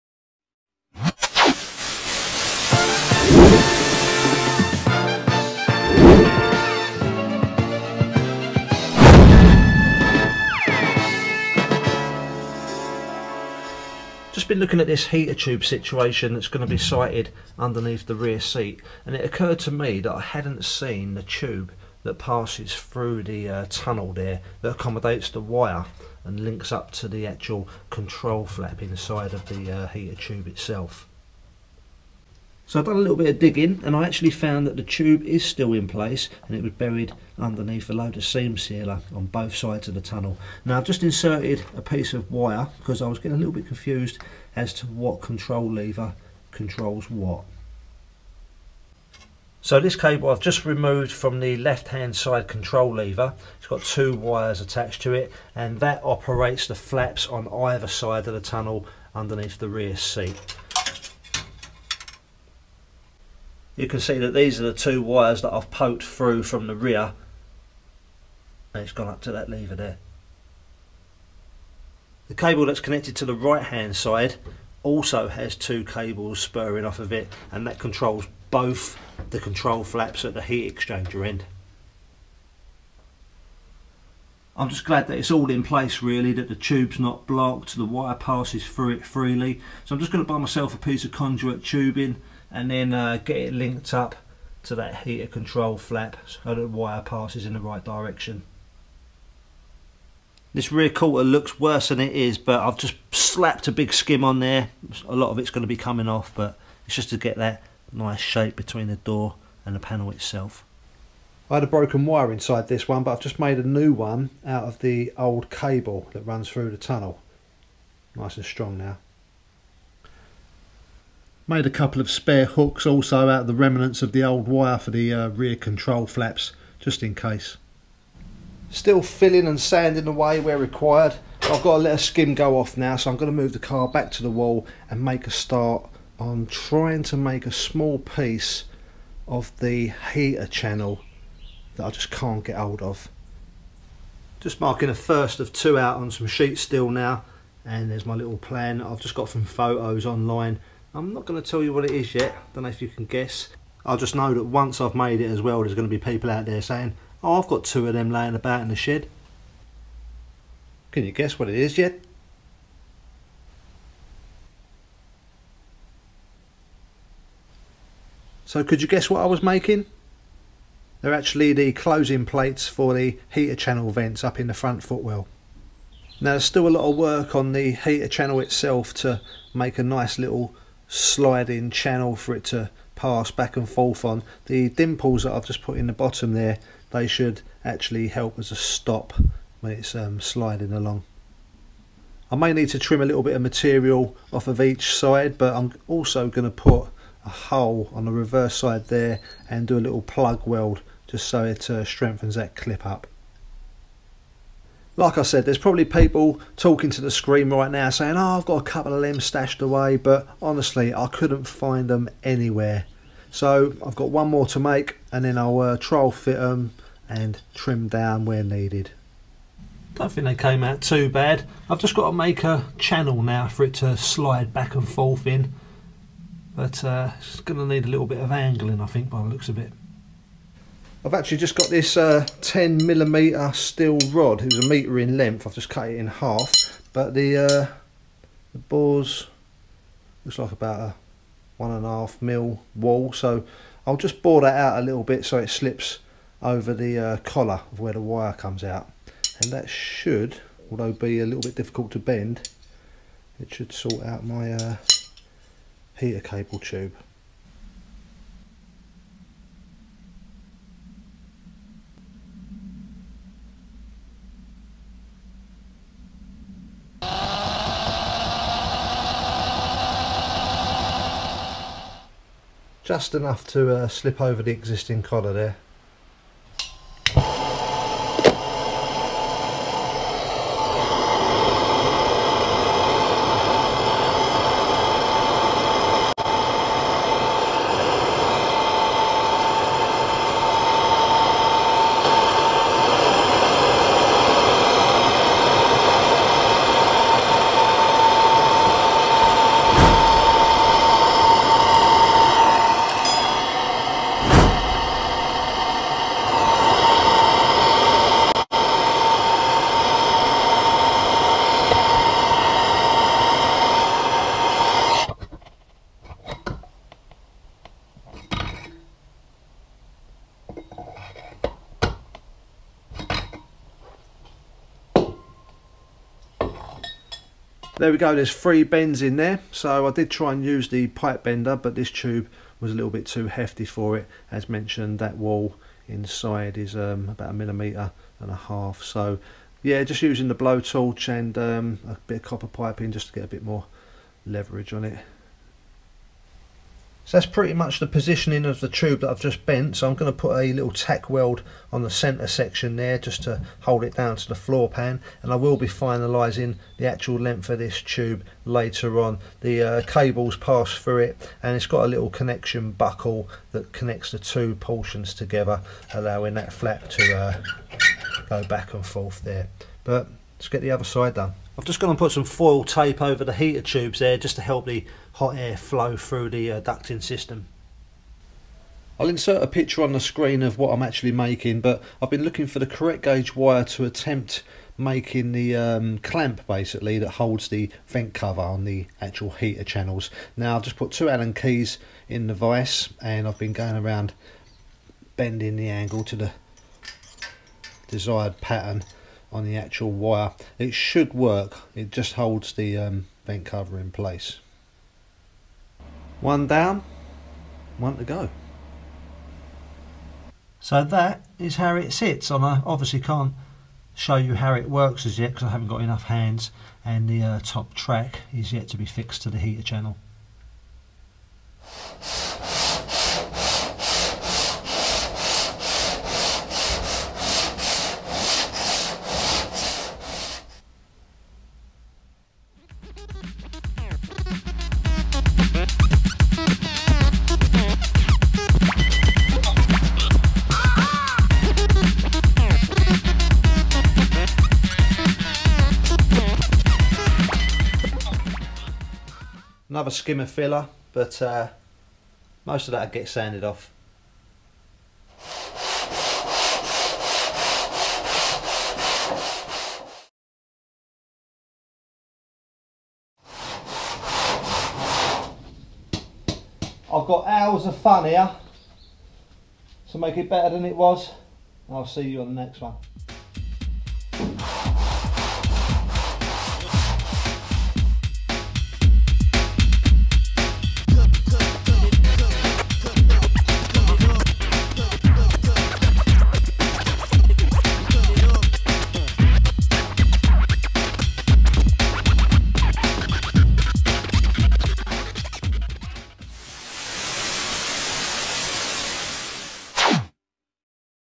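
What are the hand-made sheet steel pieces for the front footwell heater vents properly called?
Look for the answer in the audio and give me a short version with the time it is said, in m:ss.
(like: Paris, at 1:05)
closing plates, at 2:51.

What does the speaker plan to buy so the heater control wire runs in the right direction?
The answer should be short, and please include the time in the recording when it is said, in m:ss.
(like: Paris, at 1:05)
conduit tubing, at 1:31.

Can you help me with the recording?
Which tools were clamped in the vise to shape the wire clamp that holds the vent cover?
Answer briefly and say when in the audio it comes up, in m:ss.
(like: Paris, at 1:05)
Allen keys, at 6:31.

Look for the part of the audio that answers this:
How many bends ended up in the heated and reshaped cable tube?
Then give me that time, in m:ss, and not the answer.
5:28.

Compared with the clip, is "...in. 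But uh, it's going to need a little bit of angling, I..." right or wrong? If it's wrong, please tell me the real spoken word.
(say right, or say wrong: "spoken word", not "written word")
right.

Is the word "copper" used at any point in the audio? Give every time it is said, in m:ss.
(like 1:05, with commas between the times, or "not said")
5:42.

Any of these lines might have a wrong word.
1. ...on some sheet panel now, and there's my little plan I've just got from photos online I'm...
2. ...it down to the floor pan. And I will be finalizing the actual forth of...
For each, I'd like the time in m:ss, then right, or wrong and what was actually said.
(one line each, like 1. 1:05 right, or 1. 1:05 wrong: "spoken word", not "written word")
1. 2:25 wrong: "steel", not "panel"
2. 5:53 wrong: "length", not "forth".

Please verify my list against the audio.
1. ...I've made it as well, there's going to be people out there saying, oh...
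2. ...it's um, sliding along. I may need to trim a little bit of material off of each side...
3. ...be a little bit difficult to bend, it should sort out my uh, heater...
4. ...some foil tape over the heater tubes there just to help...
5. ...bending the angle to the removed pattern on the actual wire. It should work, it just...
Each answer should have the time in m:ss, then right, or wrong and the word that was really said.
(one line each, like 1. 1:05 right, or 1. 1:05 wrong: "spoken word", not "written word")
1. 2:34 right
2. 3:09 right
3. 4:10 right
4. 6:12 right
5. 6:35 wrong: "desired", not "removed".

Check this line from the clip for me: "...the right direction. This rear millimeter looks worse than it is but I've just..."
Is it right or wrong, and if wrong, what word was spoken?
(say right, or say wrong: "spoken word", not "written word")
wrong: "quarter", not "millimeter".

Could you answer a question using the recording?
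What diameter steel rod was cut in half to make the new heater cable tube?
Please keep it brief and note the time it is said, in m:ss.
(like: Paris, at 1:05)
10 mm, at 3:52.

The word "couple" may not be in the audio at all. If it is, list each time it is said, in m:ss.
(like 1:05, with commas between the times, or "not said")
2:01, 3:28.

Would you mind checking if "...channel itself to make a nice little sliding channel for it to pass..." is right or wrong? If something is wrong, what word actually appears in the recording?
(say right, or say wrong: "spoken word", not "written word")
right.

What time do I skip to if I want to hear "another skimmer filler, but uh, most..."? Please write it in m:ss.
7:29.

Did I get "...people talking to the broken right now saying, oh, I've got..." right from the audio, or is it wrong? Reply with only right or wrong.
wrong.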